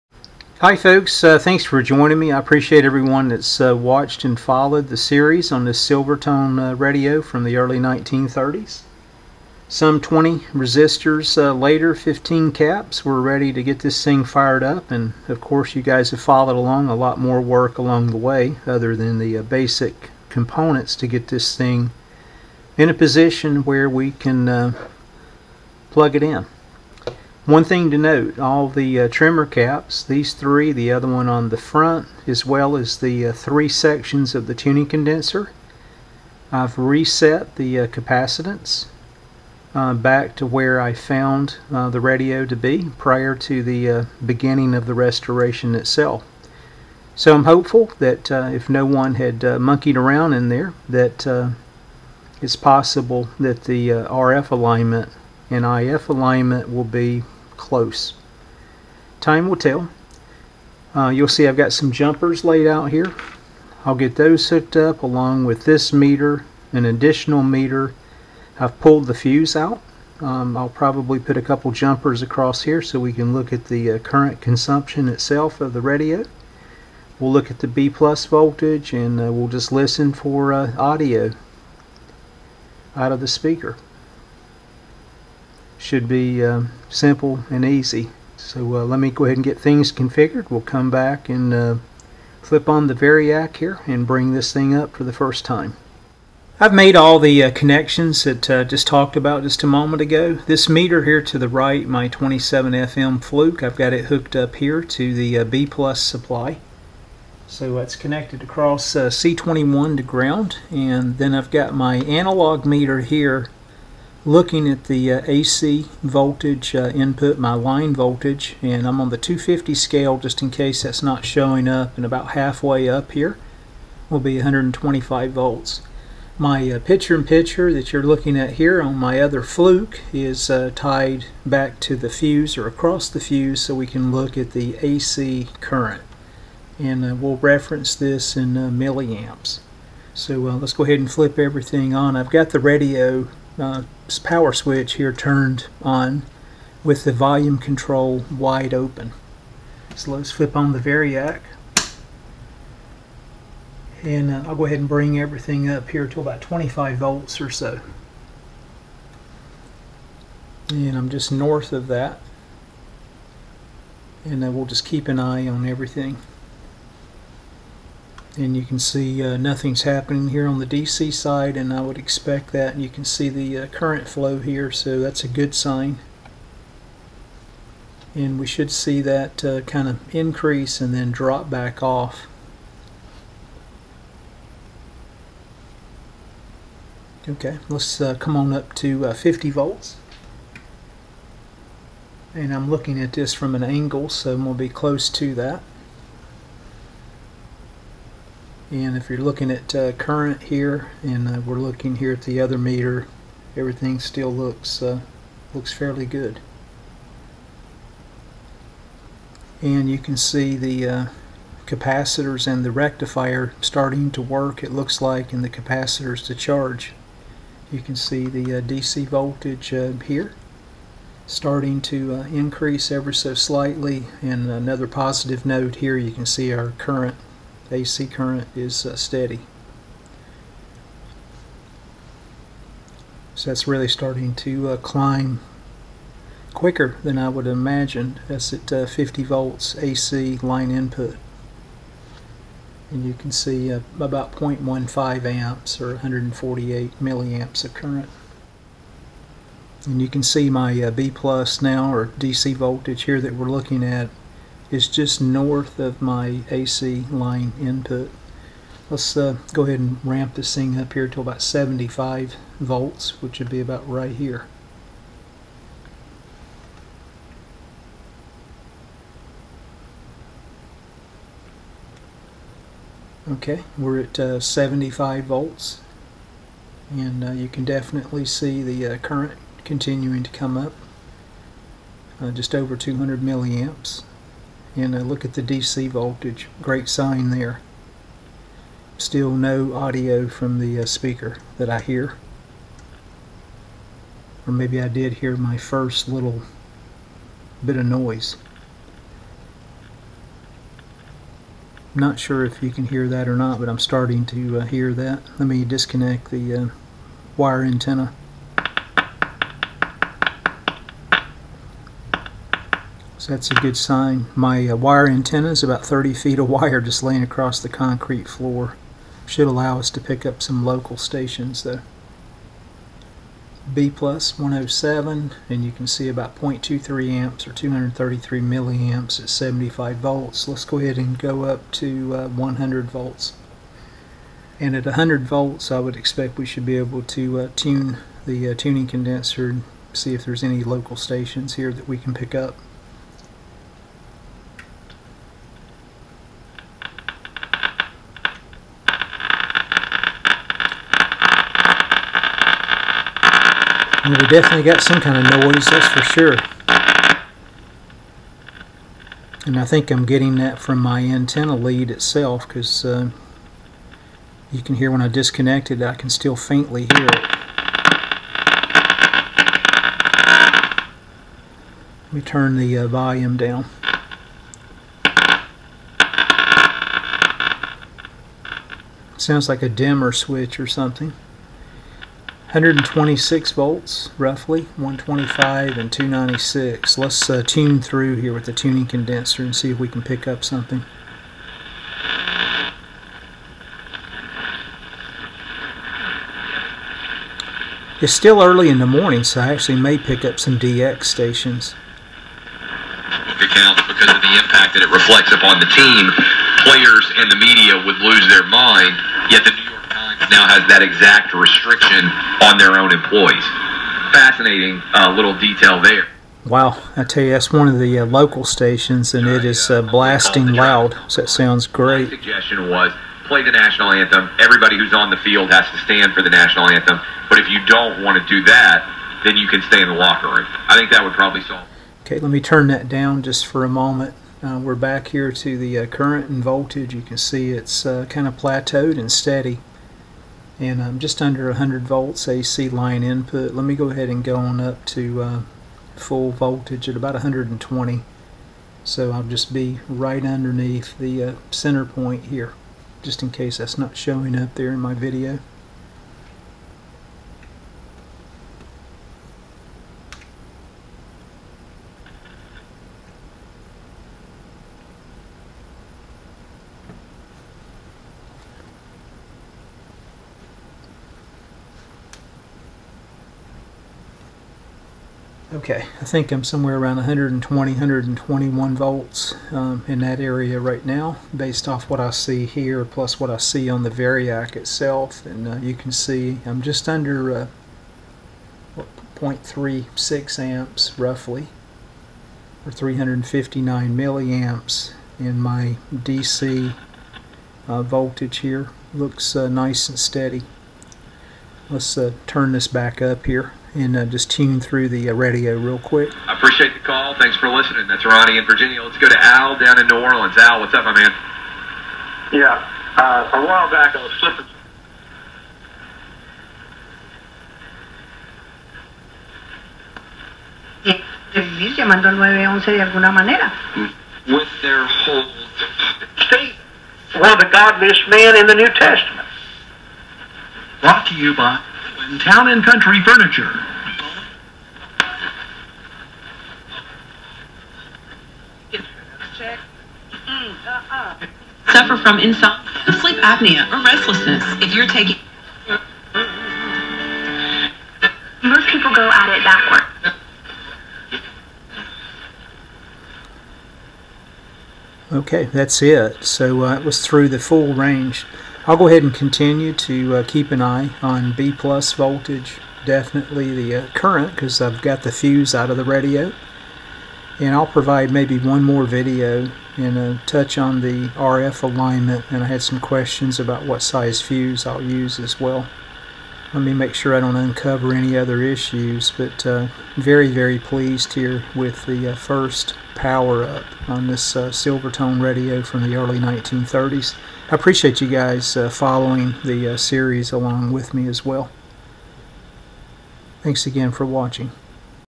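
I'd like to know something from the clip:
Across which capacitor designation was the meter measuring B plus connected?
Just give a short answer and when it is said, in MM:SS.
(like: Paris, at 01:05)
C21, at 01:49.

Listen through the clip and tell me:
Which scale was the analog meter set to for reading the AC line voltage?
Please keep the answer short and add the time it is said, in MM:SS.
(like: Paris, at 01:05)
250, at 01:59.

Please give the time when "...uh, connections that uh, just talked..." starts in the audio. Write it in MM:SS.
01:37.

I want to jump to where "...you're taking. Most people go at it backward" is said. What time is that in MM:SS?
09:04.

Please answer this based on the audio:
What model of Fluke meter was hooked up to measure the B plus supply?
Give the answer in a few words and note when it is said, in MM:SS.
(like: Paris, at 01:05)
27 FM, at 01:42.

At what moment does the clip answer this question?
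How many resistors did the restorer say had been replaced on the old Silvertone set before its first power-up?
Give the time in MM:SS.
00:09.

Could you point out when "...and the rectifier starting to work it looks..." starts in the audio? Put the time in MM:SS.
03:32.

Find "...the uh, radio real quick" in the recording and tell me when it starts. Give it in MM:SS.
08:24.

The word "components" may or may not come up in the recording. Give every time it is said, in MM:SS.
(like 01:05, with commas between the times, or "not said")
00:20.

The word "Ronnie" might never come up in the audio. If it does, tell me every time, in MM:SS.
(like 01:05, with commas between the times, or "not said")
08:28.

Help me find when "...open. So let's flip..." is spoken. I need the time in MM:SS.
02:28.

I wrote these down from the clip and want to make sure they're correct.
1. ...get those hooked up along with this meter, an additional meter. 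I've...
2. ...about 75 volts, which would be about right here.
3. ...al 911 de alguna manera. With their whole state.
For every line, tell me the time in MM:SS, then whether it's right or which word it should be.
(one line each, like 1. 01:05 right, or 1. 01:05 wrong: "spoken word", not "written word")
1. 01:03 right
2. 04:21 right
3. 08:42 right.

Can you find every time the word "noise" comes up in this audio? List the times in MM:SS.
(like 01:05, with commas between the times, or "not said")
04:57, 05:55.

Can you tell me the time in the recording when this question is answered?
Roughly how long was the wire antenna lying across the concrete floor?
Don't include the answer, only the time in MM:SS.
05:15.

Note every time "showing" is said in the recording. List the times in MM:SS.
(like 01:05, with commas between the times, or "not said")
02:01, 07:33.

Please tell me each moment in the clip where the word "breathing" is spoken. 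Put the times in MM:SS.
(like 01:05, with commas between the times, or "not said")
not said.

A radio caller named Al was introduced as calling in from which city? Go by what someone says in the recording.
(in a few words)
New Orleans.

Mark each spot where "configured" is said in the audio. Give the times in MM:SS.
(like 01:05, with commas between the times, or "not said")
01:29.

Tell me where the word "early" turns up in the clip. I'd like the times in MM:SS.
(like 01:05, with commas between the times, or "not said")
00:07, 06:38, 09:45.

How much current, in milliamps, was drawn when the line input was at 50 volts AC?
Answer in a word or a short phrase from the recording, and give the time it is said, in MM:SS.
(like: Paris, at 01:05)
148 milliamps, at 04:05.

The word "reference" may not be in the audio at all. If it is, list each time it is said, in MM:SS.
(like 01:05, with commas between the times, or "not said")
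02:17.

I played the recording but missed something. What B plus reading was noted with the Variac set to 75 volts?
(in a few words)
107.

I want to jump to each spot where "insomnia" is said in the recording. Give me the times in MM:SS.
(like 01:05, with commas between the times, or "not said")
09:02.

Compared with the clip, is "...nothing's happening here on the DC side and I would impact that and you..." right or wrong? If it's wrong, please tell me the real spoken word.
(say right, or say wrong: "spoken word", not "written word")
wrong: "expect", not "impact".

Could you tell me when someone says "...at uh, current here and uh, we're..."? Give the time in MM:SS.
03:19.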